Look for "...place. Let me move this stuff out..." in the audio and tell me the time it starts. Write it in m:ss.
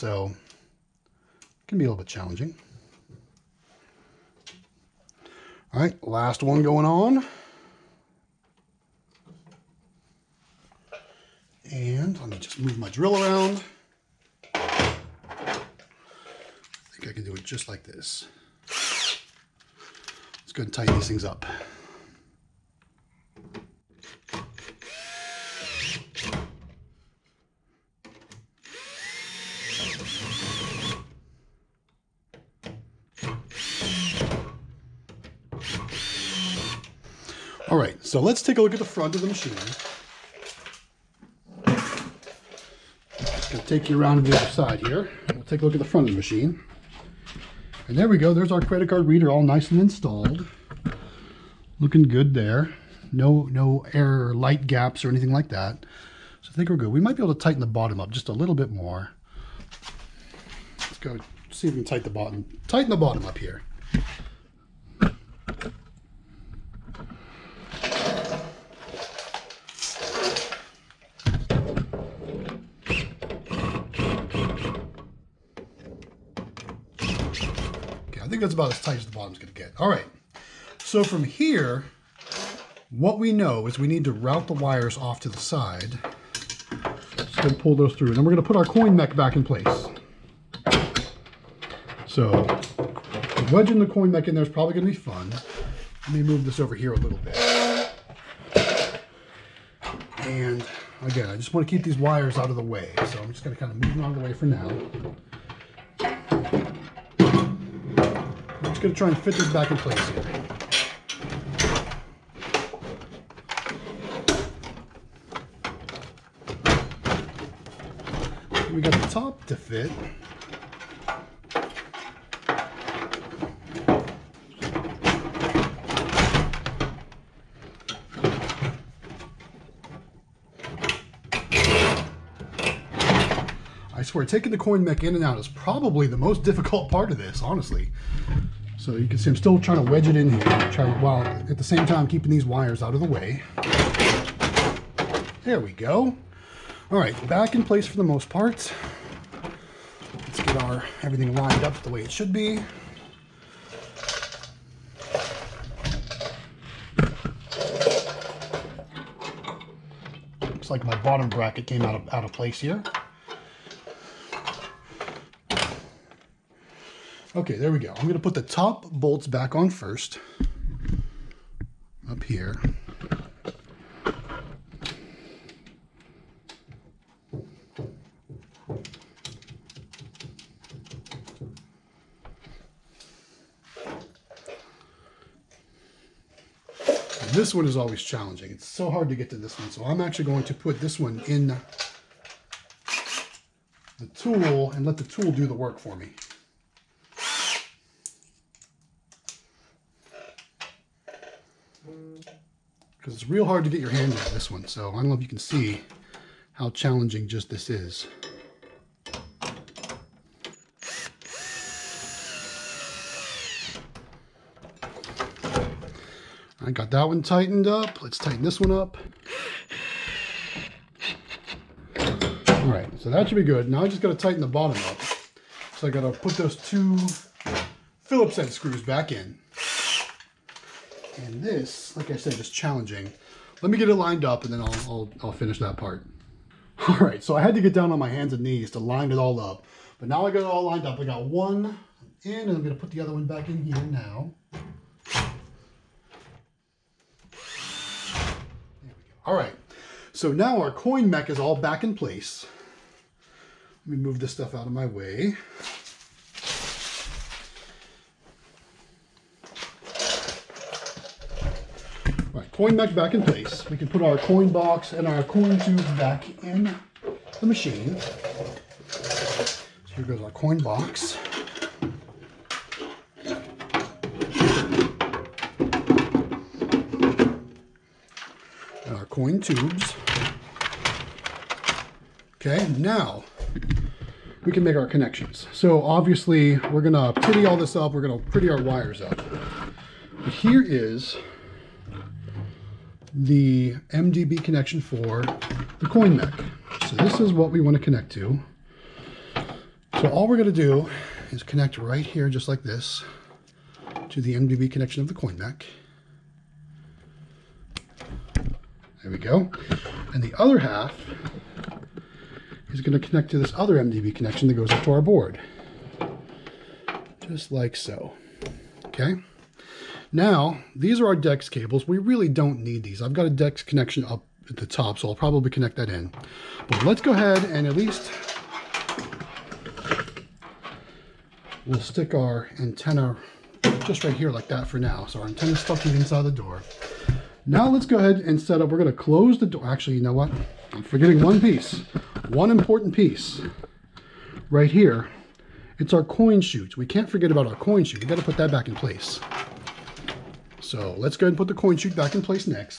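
4:11.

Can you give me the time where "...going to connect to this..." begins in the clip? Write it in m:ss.
5:12.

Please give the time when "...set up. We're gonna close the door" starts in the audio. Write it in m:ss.
5:38.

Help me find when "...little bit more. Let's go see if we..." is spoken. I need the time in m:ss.
0:58.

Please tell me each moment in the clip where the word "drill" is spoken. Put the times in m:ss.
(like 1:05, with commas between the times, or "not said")
0:12.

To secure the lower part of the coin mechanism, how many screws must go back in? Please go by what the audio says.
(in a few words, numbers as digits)
2.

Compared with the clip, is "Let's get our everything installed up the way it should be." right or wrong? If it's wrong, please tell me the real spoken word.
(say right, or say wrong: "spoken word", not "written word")
wrong: "lined", not "installed".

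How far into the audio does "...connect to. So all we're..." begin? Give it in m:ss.
4:57.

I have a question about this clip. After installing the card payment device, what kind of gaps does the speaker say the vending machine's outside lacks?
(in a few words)
air light gaps.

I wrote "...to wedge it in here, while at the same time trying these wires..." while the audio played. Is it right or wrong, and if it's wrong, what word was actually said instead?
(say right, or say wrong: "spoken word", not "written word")
wrong: "keeping", not "trying".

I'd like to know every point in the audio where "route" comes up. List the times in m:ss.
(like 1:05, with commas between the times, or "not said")
1:24.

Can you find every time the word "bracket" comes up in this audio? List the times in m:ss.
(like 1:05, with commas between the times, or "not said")
2:41.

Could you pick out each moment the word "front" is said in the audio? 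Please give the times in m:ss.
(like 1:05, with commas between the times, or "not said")
0:38, 0:45.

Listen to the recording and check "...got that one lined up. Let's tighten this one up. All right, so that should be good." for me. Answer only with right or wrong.
wrong.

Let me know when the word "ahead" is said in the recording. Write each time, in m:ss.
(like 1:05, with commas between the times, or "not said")
5:27, 5:37, 5:51.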